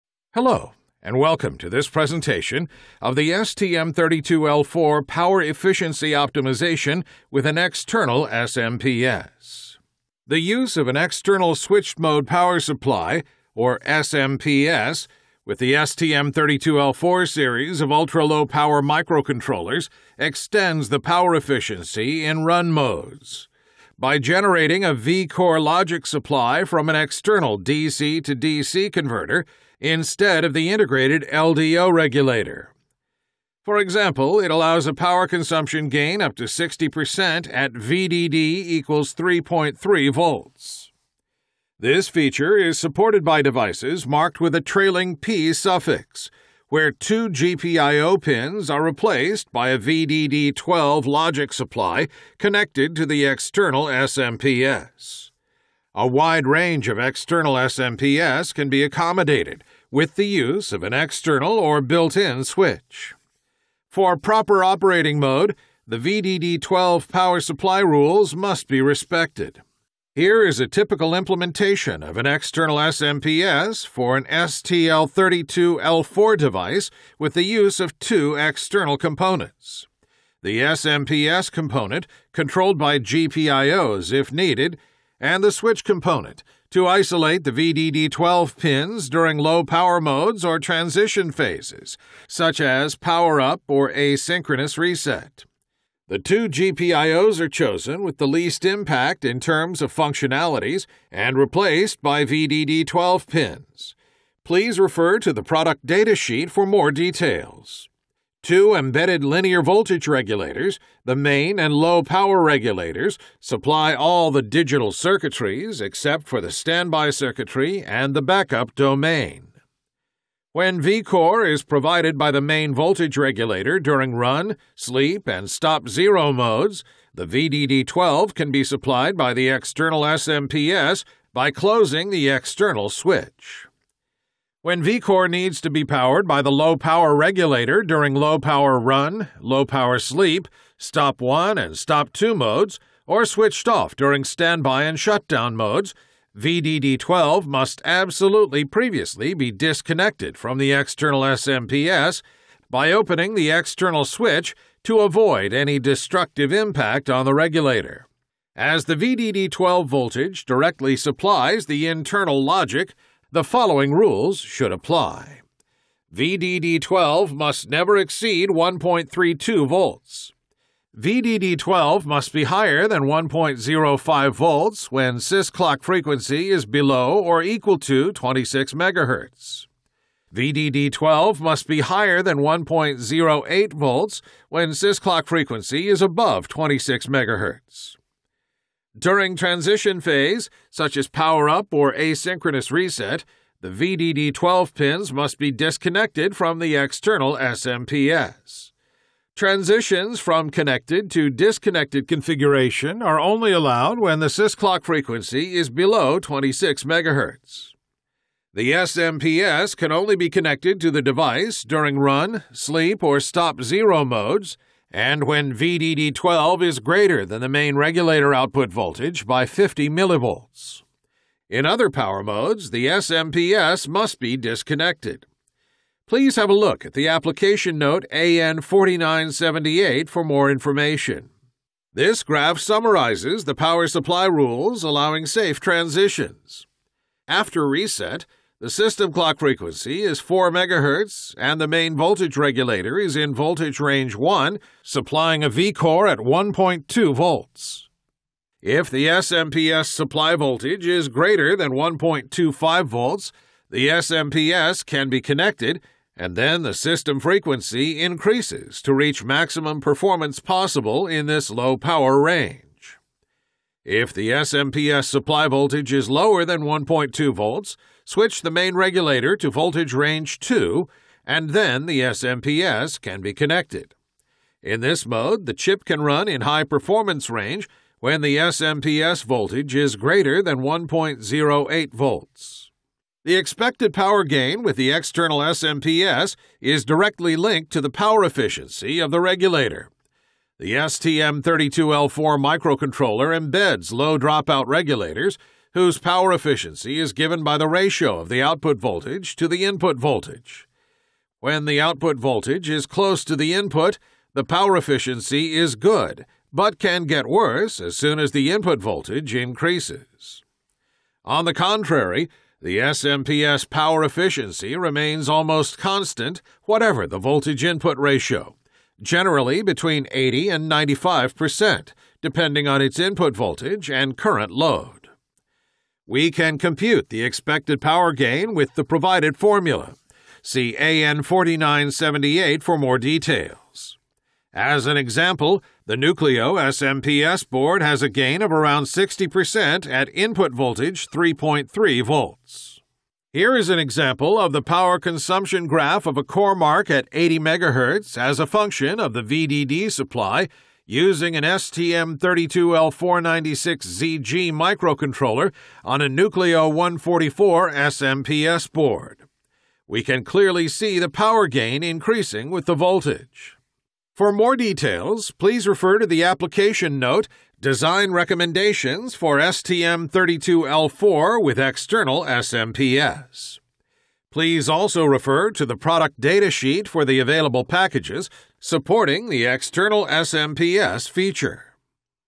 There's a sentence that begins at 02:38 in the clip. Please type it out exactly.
As the VDD12 voltage directly supplies the internal logic the following rules should apply.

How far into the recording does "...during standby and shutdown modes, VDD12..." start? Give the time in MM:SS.
02:23.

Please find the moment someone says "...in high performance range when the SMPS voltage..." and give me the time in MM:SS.
04:36.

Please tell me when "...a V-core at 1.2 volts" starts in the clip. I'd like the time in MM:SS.
04:05.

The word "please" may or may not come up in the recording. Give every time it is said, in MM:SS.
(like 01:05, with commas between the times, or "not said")
01:44, 03:46, 06:05, 06:14.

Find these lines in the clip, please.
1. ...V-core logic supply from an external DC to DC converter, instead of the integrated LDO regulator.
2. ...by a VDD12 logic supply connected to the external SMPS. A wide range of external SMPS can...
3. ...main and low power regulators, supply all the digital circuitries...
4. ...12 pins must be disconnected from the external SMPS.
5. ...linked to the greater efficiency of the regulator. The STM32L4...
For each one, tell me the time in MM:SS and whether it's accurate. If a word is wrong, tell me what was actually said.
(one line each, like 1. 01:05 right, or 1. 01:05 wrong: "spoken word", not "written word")
1. 00:24 right
2. 00:49 right
3. 01:51 right
4. 03:14 right
5. 04:47 wrong: "power", not "greater".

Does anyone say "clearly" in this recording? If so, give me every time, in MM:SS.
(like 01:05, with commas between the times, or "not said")
06:00.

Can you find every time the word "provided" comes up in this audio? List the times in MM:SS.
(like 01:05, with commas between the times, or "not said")
02:01, 05:28.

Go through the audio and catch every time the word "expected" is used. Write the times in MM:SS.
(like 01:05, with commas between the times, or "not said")
04:43, 05:27.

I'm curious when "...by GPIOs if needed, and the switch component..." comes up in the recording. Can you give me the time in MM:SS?
01:22.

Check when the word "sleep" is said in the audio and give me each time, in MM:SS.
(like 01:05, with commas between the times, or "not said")
02:04, 02:19, 03:32.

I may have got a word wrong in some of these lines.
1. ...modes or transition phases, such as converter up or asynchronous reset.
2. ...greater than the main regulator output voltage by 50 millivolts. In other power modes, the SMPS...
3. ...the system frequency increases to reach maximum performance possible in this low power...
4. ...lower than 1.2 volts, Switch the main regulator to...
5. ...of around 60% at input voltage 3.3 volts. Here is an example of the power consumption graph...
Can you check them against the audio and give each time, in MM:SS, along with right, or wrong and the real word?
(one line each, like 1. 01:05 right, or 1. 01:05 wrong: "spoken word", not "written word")
1. 01:29 wrong: "power", not "converter"
2. 03:36 right
3. 04:16 right
4. 04:26 right
5. 05:38 right.